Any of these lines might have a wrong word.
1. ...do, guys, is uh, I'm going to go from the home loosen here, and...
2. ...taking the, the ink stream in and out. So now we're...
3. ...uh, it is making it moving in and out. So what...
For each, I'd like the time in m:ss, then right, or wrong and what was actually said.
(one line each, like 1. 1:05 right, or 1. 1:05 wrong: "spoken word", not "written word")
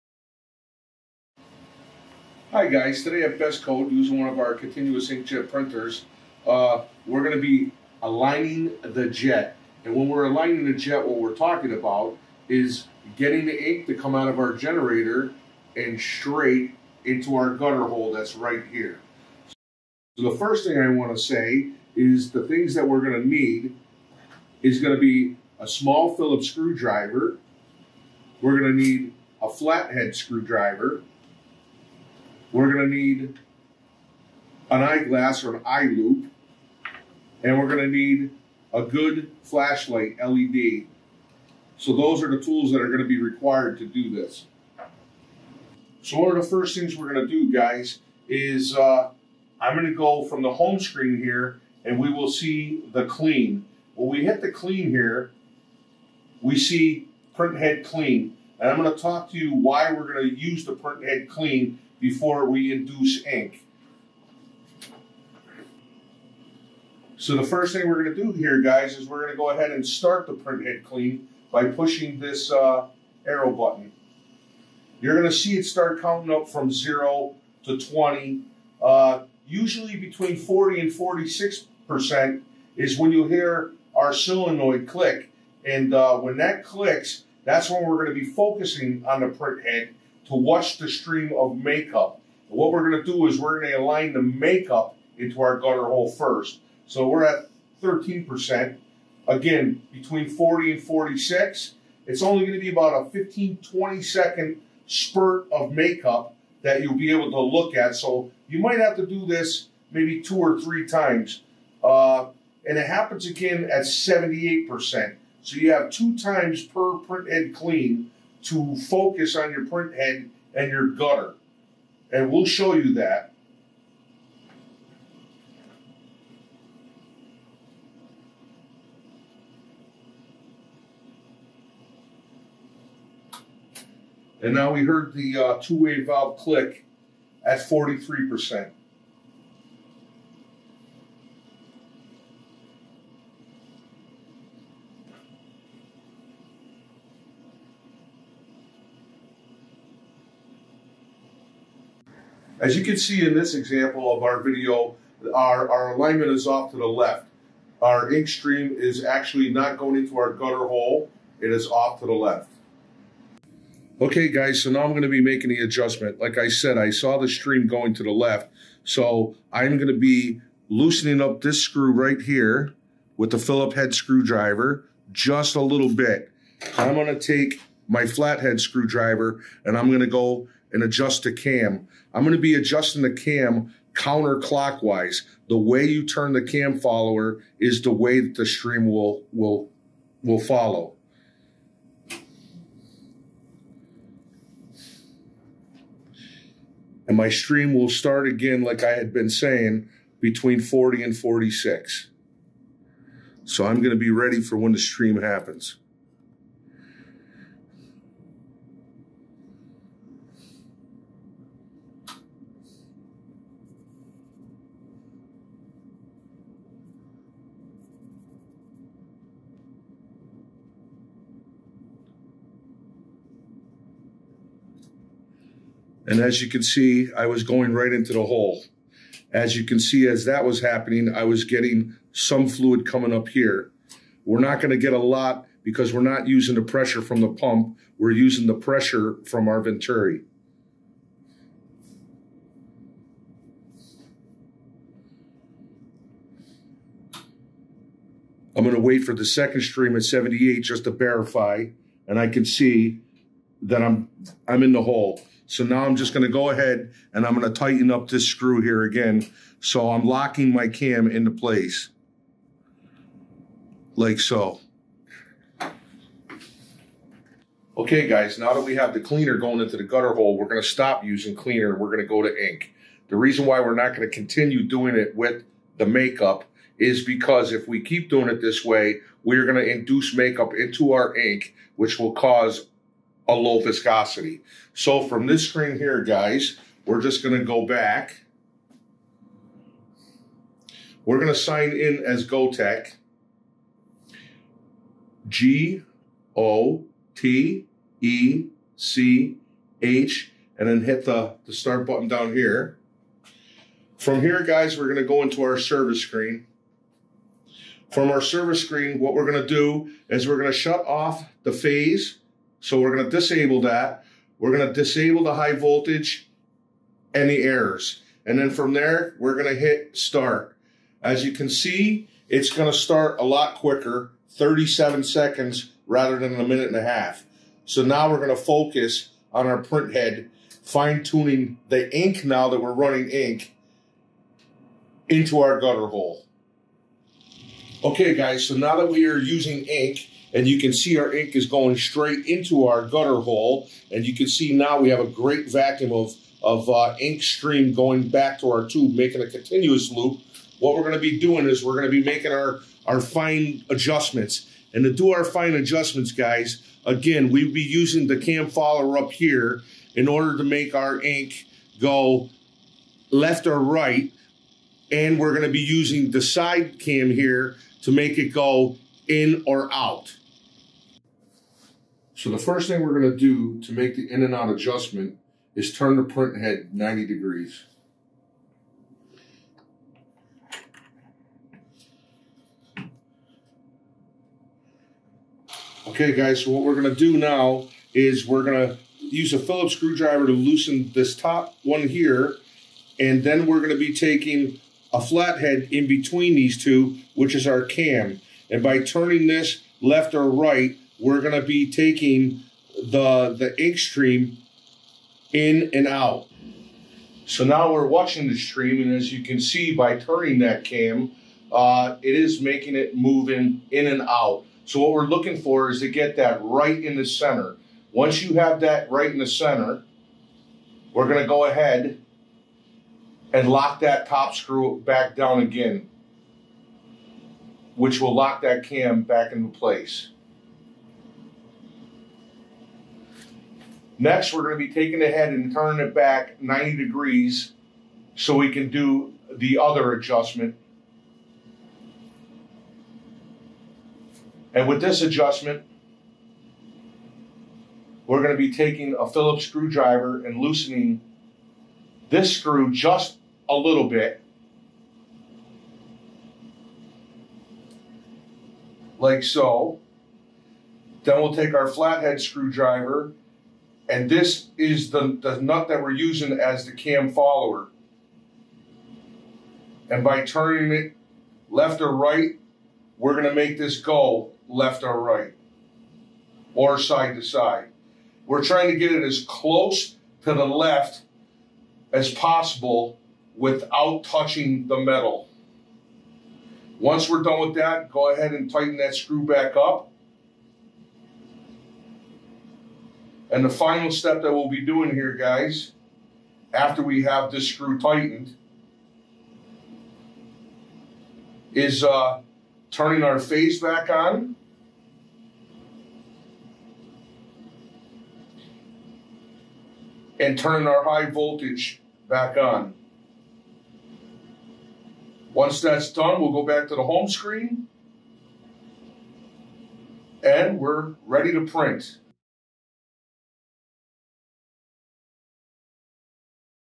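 1. 0:47 wrong: "screen", not "loosen"
2. 6:41 right
3. 6:51 right.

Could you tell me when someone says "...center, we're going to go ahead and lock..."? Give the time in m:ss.
6:59.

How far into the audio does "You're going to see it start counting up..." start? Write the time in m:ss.
1:14.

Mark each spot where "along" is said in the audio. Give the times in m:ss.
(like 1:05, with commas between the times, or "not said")
not said.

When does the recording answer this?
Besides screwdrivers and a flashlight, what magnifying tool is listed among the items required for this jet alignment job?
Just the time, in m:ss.
0:35.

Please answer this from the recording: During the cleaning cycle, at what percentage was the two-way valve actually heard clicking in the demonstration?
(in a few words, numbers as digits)
43%.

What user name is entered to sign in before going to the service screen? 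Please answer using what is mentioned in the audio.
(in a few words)
GoTech.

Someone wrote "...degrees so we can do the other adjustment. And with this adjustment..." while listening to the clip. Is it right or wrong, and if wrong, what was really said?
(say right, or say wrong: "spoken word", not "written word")
right.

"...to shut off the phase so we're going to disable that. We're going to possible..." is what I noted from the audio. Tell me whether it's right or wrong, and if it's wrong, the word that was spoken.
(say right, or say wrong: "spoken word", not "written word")
wrong: "disable", not "possible".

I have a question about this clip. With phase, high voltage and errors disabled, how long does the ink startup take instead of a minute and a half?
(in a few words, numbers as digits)
37 seconds.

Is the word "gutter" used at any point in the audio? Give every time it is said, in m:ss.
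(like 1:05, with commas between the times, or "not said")
0:17, 1:35, 2:00, 2:40, 4:29, 5:35, 5:42.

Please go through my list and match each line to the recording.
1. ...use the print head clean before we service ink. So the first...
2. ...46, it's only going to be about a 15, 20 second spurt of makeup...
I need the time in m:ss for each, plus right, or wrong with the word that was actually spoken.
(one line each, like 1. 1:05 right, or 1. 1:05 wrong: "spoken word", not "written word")
1. 1:00 wrong: "induce", not "service"
2. 1:40 right.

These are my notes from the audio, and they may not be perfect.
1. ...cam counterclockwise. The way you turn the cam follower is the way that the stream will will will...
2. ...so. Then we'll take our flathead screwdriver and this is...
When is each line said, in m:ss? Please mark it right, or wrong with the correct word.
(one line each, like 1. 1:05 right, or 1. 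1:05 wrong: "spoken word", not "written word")
1. 3:03 right
2. 7:39 right.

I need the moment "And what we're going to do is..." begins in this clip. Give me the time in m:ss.
1:32.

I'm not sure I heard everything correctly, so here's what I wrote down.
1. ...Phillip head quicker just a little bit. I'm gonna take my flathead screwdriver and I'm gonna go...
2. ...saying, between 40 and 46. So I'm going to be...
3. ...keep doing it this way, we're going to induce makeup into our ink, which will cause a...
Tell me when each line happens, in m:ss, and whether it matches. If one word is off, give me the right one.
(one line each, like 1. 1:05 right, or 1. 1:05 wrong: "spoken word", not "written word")
1. 2:53 wrong: "screwdriver", not "quicker"
2. 3:19 right
3. 4:37 right.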